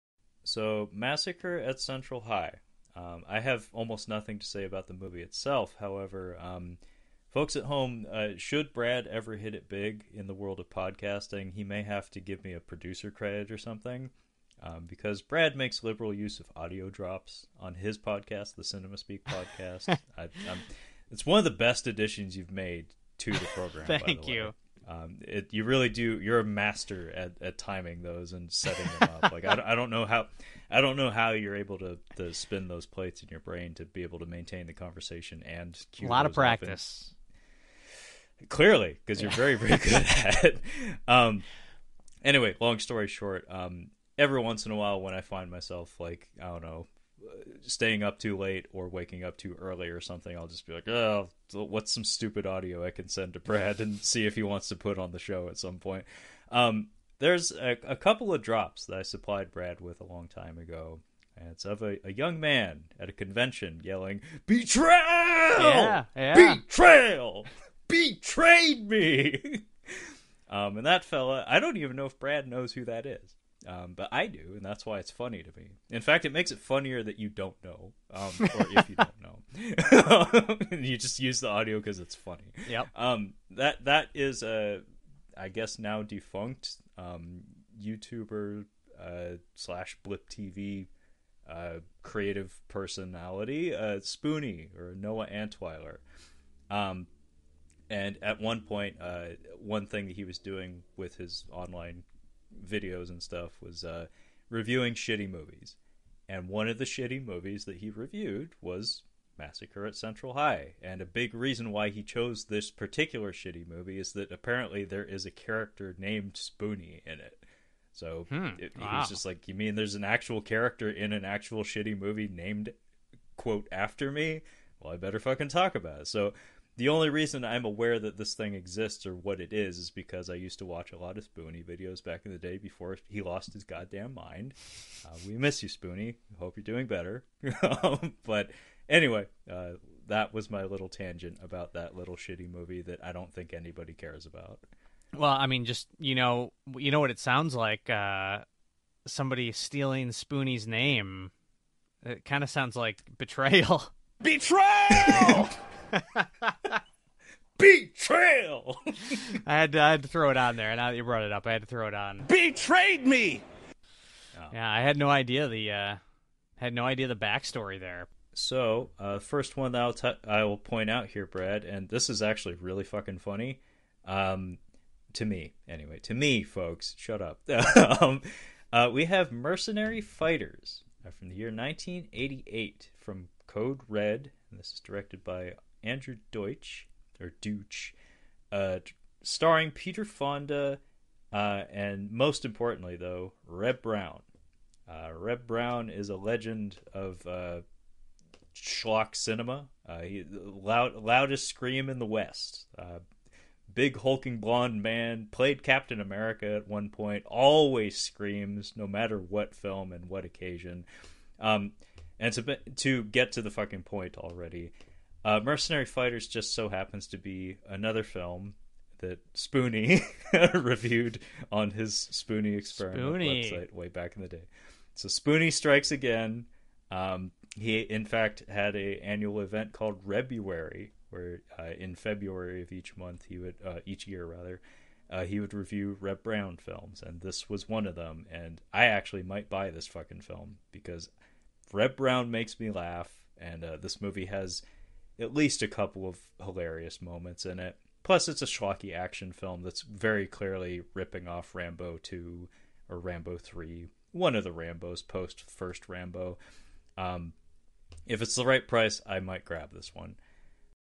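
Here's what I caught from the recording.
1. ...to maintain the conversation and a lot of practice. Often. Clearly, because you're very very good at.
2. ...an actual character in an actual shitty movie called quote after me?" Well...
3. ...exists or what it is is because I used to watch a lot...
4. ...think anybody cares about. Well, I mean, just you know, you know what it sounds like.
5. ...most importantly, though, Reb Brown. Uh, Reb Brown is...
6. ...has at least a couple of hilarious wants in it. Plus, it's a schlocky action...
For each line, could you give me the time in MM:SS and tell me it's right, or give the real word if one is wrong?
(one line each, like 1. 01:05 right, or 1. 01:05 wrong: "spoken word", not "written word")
1. 00:34 right
2. 01:59 wrong: "named", not "called"
3. 02:08 right
4. 02:23 right
5. 03:12 right
6. 04:04 wrong: "moments", not "wants".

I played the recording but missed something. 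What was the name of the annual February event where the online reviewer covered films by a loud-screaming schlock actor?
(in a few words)
Rebruary.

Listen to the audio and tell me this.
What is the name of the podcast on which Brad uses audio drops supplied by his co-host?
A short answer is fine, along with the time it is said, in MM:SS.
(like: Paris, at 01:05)
Cinema Speak podcast, at 00:18.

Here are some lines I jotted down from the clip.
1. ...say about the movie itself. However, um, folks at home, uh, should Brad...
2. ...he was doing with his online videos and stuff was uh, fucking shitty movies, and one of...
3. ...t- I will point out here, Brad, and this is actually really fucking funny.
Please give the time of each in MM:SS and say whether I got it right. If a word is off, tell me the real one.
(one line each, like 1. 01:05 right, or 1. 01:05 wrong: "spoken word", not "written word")
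1. 00:04 right
2. 01:40 wrong: "reviewing", not "fucking"
3. 02:49 right.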